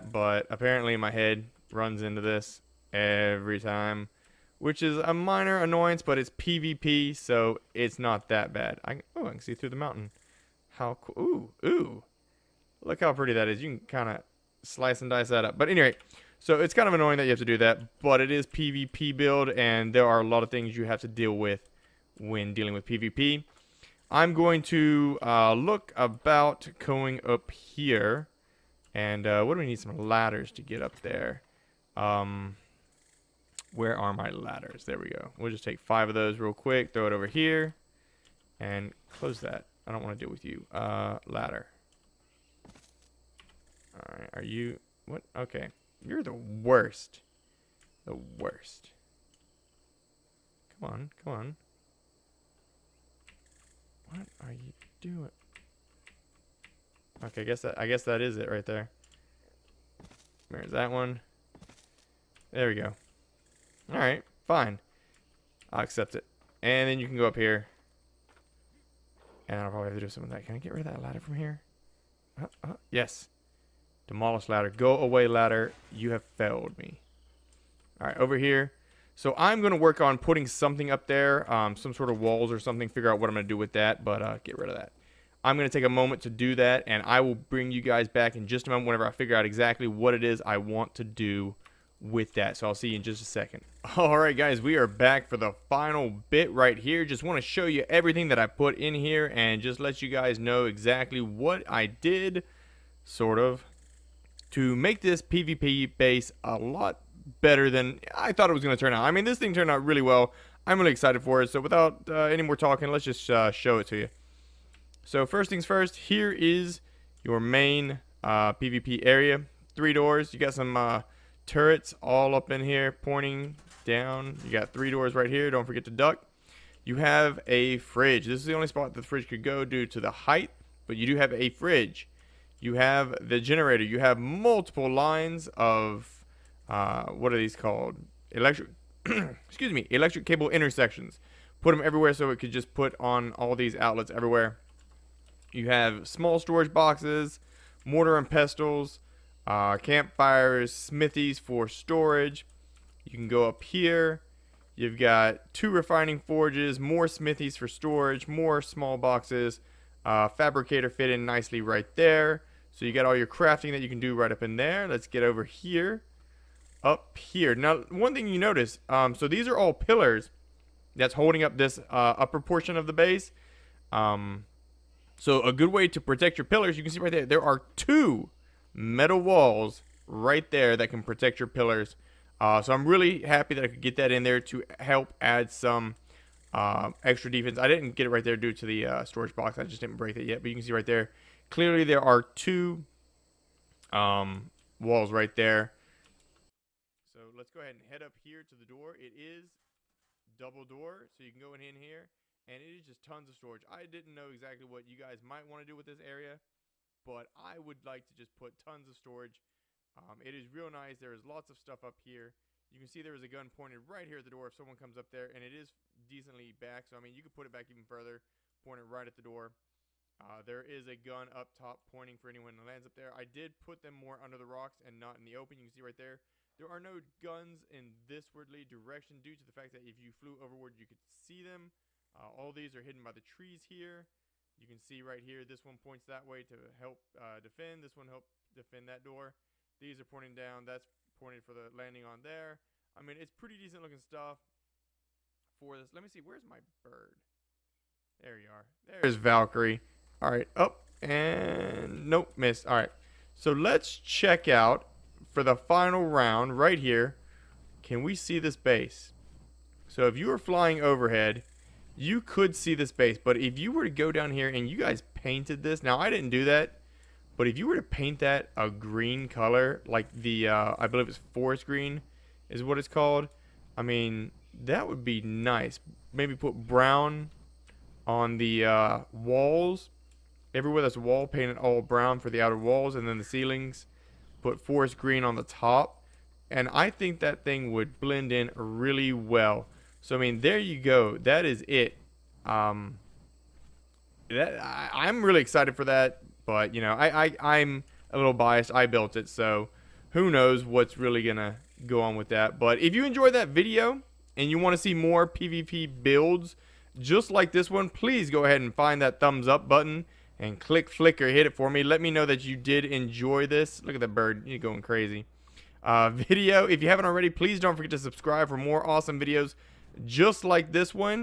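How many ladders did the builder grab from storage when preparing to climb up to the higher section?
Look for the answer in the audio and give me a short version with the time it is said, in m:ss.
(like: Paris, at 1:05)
5, at 0:35.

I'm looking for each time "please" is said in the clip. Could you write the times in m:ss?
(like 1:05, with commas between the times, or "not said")
5:07, 5:17.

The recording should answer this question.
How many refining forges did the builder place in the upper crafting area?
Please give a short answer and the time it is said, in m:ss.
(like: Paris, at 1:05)
2, at 2:35.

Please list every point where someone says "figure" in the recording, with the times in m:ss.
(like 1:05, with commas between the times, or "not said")
1:22, 1:29.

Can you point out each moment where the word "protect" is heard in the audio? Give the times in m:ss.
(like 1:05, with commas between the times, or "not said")
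2:56, 3:01.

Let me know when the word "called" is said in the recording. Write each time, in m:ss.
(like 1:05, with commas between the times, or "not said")
2:17, 4:32.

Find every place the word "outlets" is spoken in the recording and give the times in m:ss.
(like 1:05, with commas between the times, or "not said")
2:23.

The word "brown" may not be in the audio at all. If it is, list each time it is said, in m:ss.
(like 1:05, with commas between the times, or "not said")
4:36, 4:41.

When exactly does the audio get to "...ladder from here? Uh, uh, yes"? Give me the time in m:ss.
1:11.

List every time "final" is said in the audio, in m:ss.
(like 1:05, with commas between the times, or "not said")
1:35, 4:15.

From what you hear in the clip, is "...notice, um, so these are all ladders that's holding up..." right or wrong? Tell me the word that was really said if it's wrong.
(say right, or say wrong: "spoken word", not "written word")
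wrong: "pillars", not "ladders".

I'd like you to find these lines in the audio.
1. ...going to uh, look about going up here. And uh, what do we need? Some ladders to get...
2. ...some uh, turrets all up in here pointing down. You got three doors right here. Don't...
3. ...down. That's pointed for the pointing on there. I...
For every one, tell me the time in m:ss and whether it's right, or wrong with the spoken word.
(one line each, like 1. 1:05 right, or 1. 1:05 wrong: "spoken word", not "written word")
1. 0:24 right
2. 2:00 right
3. 4:00 wrong: "landing", not "pointing".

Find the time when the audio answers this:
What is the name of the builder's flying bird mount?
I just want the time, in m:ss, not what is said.
4:09.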